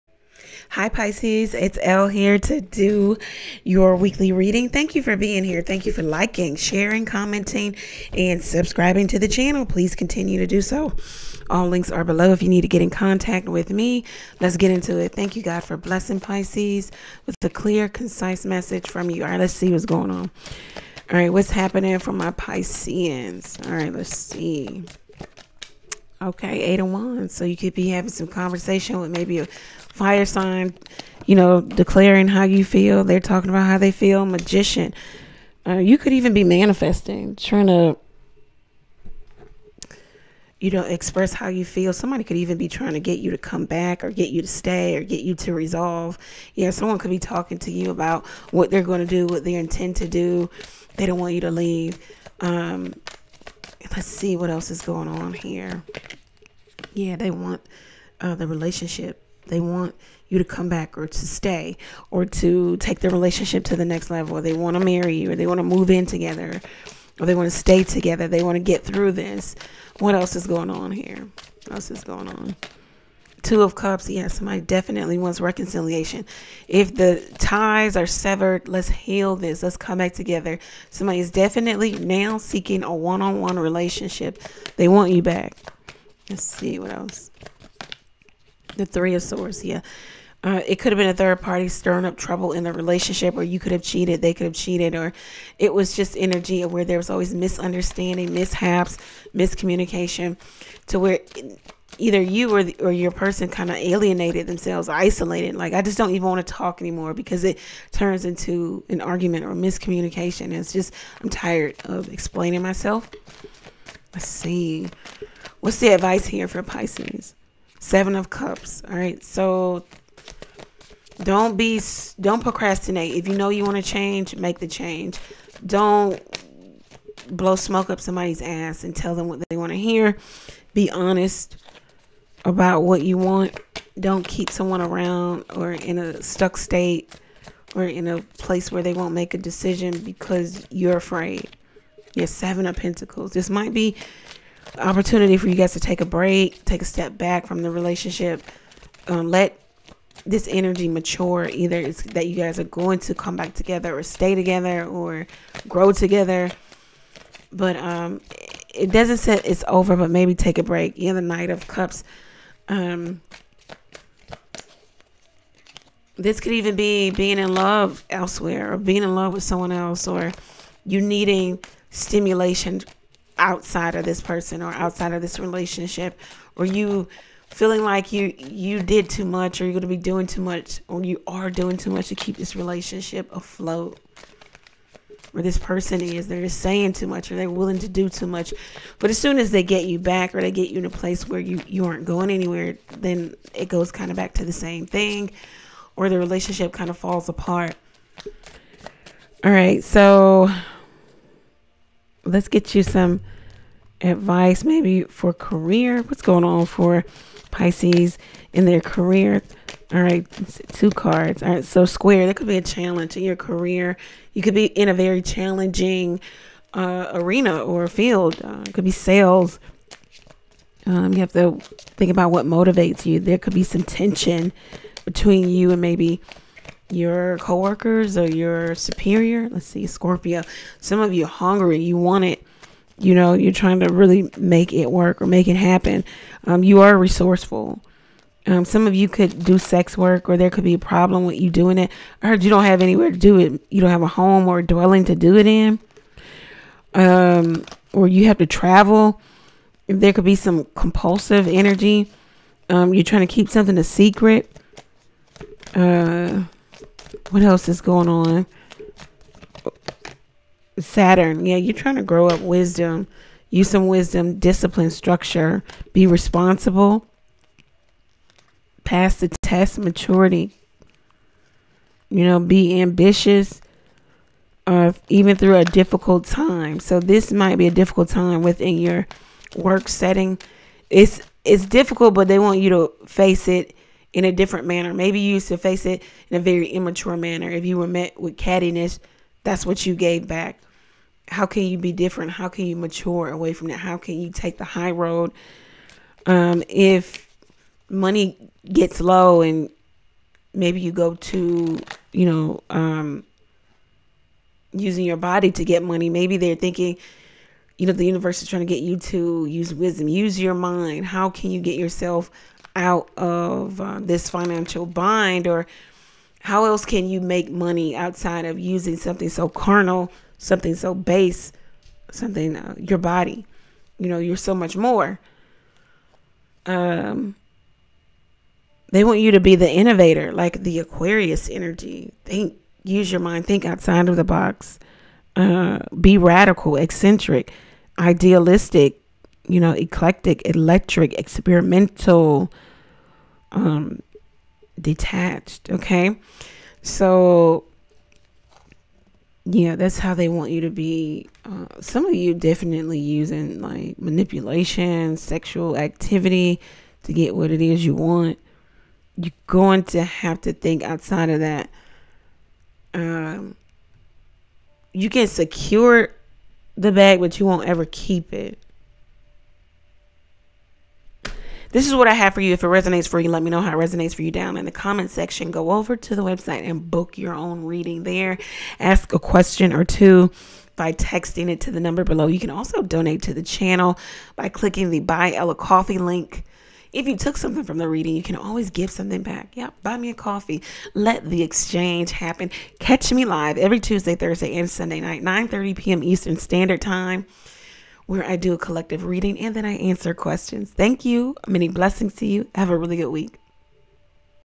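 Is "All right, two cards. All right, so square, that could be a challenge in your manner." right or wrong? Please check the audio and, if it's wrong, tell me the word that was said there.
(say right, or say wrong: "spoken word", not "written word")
wrong: "career", not "manner".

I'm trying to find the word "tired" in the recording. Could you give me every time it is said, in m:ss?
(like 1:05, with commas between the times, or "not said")
1:51.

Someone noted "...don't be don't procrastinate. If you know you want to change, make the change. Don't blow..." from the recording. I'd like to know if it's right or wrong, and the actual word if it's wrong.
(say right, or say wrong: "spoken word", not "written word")
right.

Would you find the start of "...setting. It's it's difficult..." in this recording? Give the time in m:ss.
4:39.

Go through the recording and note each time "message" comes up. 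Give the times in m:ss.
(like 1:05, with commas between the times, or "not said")
0:18.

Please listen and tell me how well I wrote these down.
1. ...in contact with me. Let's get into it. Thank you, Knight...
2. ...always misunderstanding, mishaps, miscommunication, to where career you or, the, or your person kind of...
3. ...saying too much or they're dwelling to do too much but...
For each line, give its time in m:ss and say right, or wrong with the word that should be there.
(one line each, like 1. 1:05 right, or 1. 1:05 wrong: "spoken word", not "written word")
1. 0:12 wrong: "God", not "Knight"
2. 1:37 wrong: "either", not "career"
3. 3:06 wrong: "willing", not "dwelling".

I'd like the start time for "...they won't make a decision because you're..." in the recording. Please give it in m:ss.
2:18.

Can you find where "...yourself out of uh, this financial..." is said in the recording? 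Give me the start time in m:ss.
5:11.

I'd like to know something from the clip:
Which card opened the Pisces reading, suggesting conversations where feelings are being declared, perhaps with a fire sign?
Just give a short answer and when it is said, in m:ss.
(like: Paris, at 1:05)
Eight of Wands, at 0:26.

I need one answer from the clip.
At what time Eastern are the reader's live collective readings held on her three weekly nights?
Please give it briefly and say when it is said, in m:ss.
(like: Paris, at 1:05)
9:30 p.m., at 6:35.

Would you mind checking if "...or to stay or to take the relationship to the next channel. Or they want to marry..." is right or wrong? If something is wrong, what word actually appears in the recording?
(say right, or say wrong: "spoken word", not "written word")
wrong: "level", not "channel".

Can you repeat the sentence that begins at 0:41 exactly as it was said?
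Somebody could even be trying to get you to come back or get you to stay or get you to resolve.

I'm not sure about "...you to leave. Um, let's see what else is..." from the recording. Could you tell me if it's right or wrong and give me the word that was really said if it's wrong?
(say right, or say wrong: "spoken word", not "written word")
right.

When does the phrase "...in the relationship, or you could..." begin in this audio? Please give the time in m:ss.
1:32.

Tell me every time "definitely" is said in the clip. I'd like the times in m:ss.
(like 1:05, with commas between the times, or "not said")
1:14, 1:21, 5:52.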